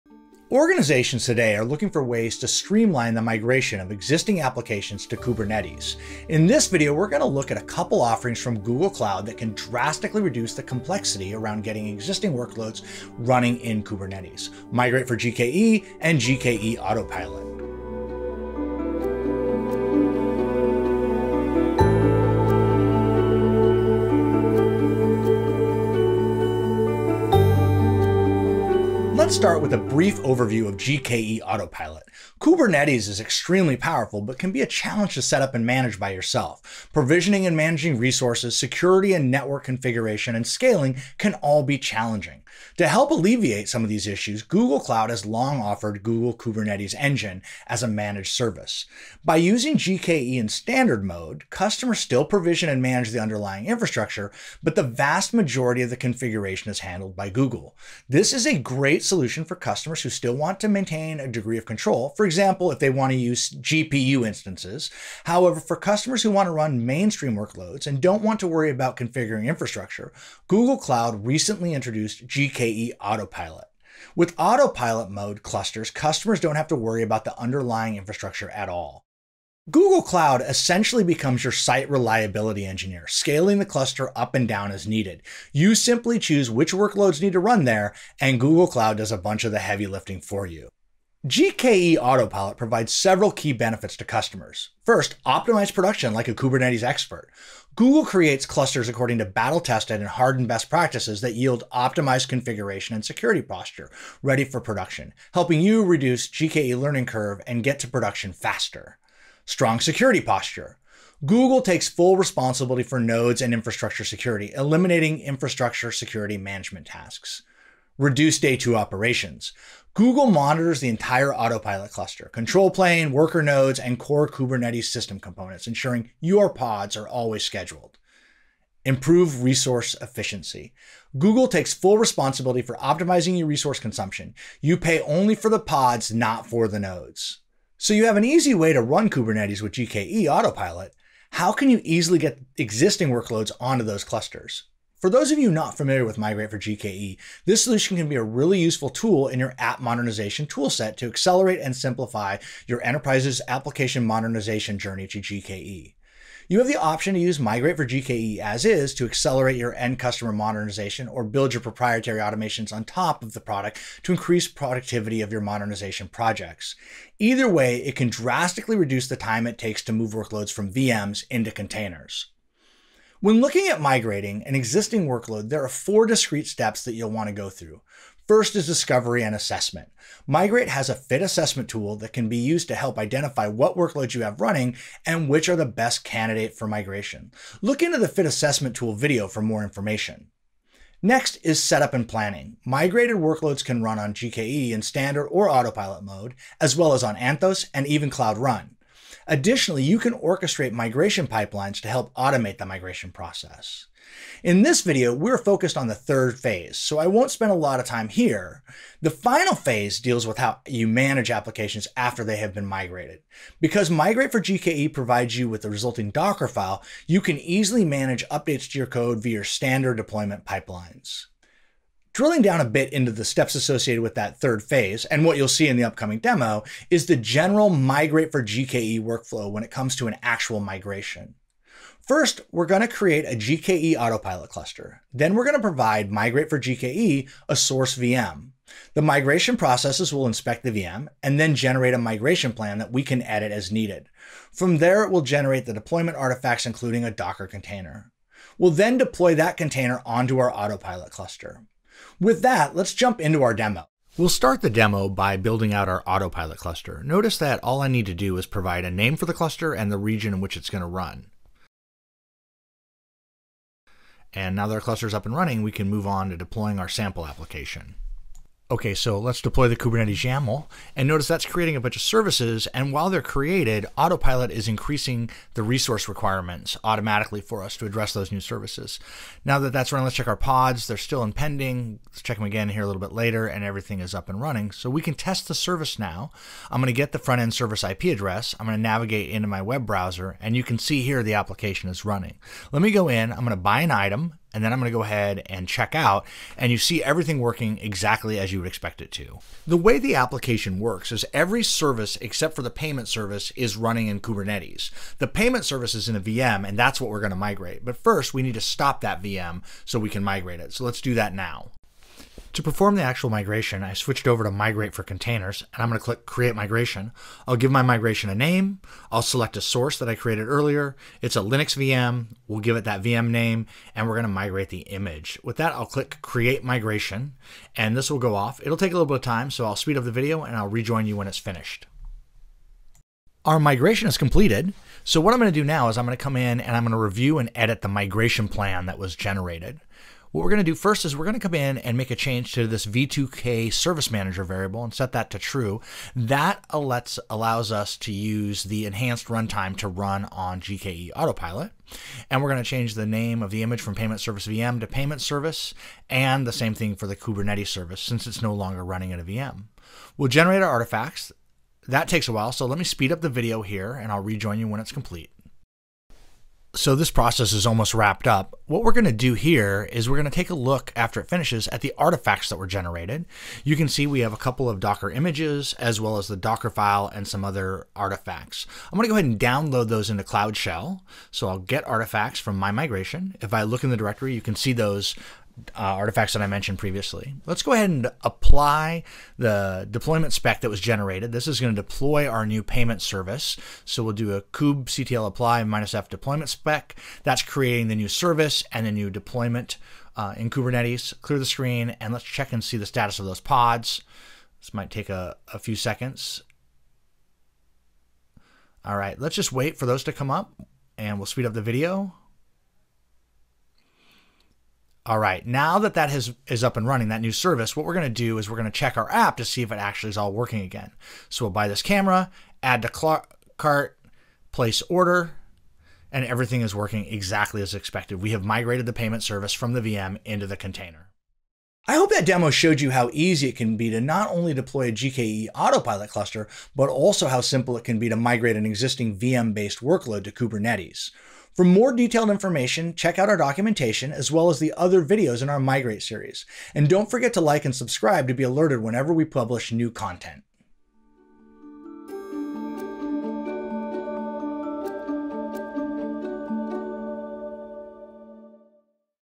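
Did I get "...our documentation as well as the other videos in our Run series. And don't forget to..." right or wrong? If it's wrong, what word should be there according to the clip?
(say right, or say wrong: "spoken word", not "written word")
wrong: "Migrate", not "Run".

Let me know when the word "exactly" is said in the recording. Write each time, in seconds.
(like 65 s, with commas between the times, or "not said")
297 s, 427 s.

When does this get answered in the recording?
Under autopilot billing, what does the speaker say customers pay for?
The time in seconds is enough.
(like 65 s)
135 s.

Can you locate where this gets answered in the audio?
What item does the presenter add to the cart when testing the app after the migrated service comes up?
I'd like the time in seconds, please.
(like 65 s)
421 s.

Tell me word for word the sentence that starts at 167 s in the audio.
Either way, it can drastically reduce the time it takes to move workloads from VMs into containers.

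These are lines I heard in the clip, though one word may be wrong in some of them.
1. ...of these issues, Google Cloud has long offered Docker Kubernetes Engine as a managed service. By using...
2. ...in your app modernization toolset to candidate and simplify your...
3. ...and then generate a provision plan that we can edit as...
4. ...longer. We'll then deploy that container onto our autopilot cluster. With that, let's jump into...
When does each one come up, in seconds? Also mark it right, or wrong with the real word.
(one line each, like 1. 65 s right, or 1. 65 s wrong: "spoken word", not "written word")
1. 43 s wrong: "Google", not "Docker"
2. 149 s wrong: "accelerate", not "candidate"
3. 241 s wrong: "migration", not "provision"
4. 247 s wrong: "container", not "longer".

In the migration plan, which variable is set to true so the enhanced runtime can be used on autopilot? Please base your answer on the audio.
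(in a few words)
v2k service manager.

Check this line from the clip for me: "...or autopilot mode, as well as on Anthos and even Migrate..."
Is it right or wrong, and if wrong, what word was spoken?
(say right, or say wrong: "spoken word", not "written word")
wrong: "Cloud", not "Migrate".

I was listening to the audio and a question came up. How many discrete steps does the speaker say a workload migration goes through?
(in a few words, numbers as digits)
4.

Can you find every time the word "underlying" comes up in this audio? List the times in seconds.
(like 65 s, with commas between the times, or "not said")
53 s, 77 s.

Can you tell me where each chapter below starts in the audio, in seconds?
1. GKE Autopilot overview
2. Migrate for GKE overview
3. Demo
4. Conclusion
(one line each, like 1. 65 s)
1. 30 s
2. 140 s
3. 221 s
4. 432 s.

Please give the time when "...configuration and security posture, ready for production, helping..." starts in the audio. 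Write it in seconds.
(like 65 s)
102 s.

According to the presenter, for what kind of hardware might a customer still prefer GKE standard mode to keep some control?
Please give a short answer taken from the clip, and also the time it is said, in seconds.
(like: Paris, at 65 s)
GPU instances, at 63 s.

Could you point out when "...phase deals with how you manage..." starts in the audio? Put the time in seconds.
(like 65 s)
209 s.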